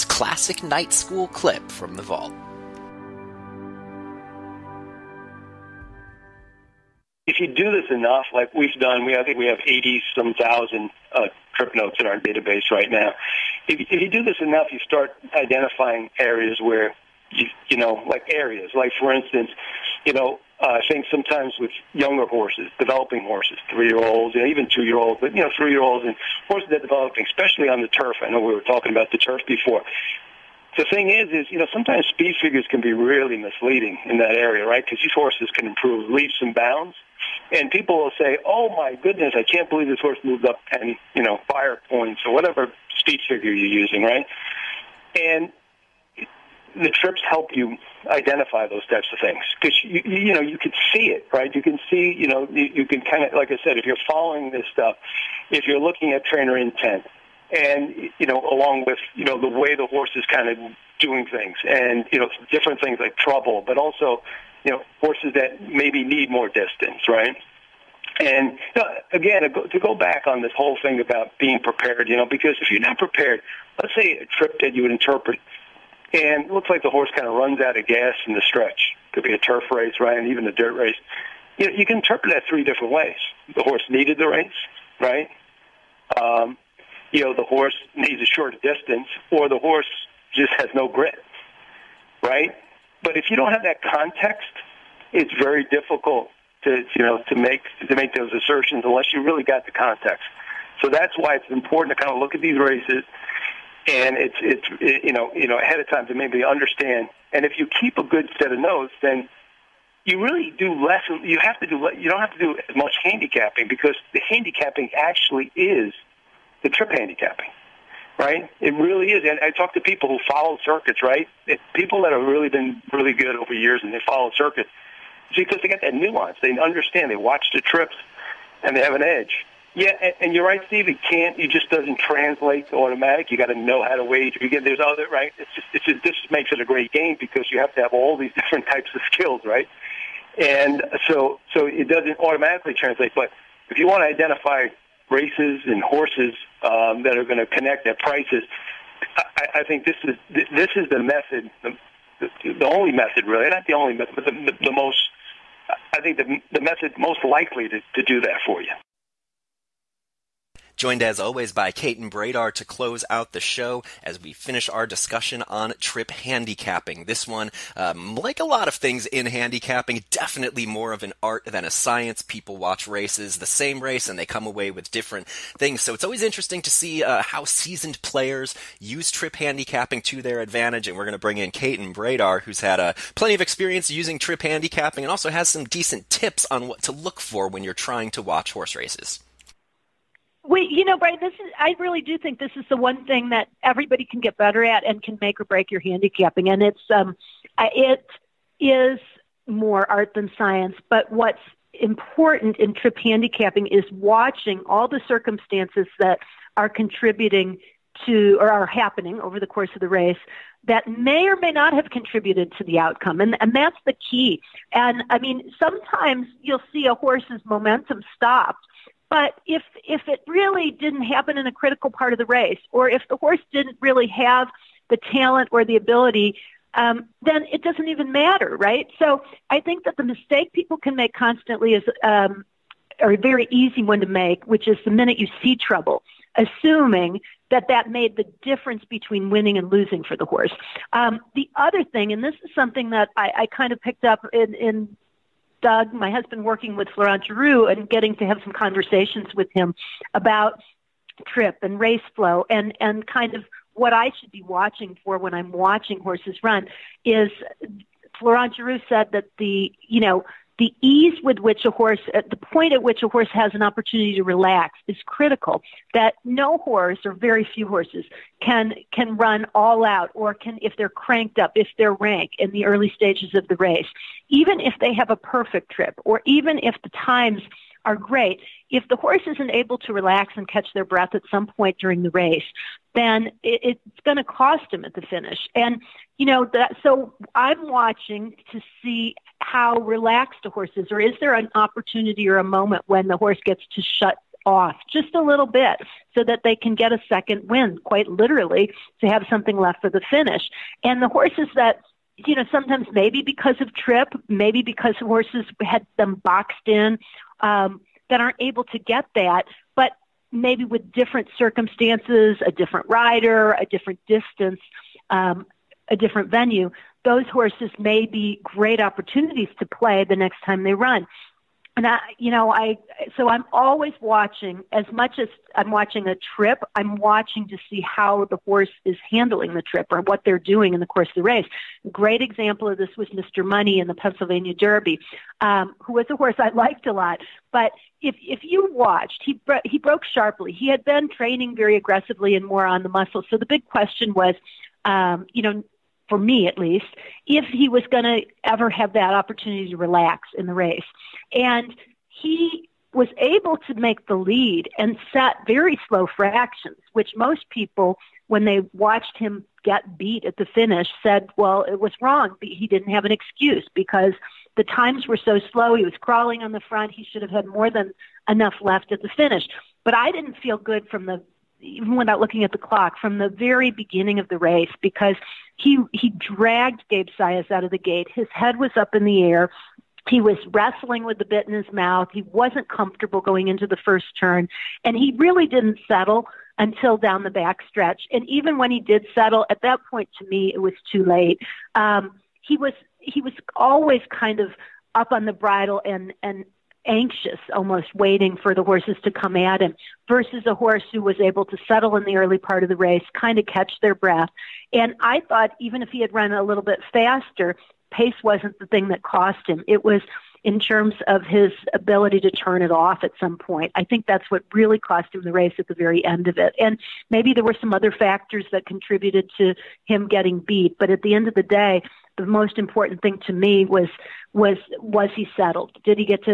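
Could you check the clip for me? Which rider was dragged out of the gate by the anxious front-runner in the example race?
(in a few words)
Gabe Saez.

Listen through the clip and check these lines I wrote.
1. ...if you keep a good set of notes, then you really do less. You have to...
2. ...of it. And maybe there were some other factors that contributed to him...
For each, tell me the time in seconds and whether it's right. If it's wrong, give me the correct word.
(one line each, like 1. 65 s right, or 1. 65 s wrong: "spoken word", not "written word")
1. 107 s right
2. 416 s right.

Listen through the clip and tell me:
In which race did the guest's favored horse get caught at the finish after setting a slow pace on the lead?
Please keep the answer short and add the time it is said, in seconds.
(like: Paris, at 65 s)
Pennsylvania Derby, at 333 s.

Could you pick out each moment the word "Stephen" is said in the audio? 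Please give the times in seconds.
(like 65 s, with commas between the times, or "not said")
not said.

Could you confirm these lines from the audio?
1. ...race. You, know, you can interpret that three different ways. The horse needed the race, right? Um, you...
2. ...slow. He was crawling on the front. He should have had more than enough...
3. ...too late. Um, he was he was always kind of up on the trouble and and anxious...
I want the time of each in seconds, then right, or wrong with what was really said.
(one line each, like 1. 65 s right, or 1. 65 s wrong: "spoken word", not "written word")
1. 80 s right
2. 365 s right
3. 390 s wrong: "bridle", not "trouble".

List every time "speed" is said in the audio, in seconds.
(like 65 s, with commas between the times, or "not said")
32 s, 42 s.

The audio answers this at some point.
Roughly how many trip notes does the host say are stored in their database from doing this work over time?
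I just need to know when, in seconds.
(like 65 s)
9 s.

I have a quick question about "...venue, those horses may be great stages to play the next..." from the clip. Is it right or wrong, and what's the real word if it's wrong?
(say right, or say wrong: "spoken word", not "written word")
wrong: "opportunities", not "stages".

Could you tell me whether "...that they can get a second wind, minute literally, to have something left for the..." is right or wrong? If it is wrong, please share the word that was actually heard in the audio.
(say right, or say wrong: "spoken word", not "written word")
wrong: "quite", not "minute".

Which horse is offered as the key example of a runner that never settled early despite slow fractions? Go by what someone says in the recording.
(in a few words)
Mr. Money.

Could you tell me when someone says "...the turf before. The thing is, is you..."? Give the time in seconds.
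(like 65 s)
29 s.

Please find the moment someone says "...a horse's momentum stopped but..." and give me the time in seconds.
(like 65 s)
216 s.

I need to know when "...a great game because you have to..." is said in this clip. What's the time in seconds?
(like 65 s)
136 s.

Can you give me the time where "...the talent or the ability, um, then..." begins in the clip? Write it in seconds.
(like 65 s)
224 s.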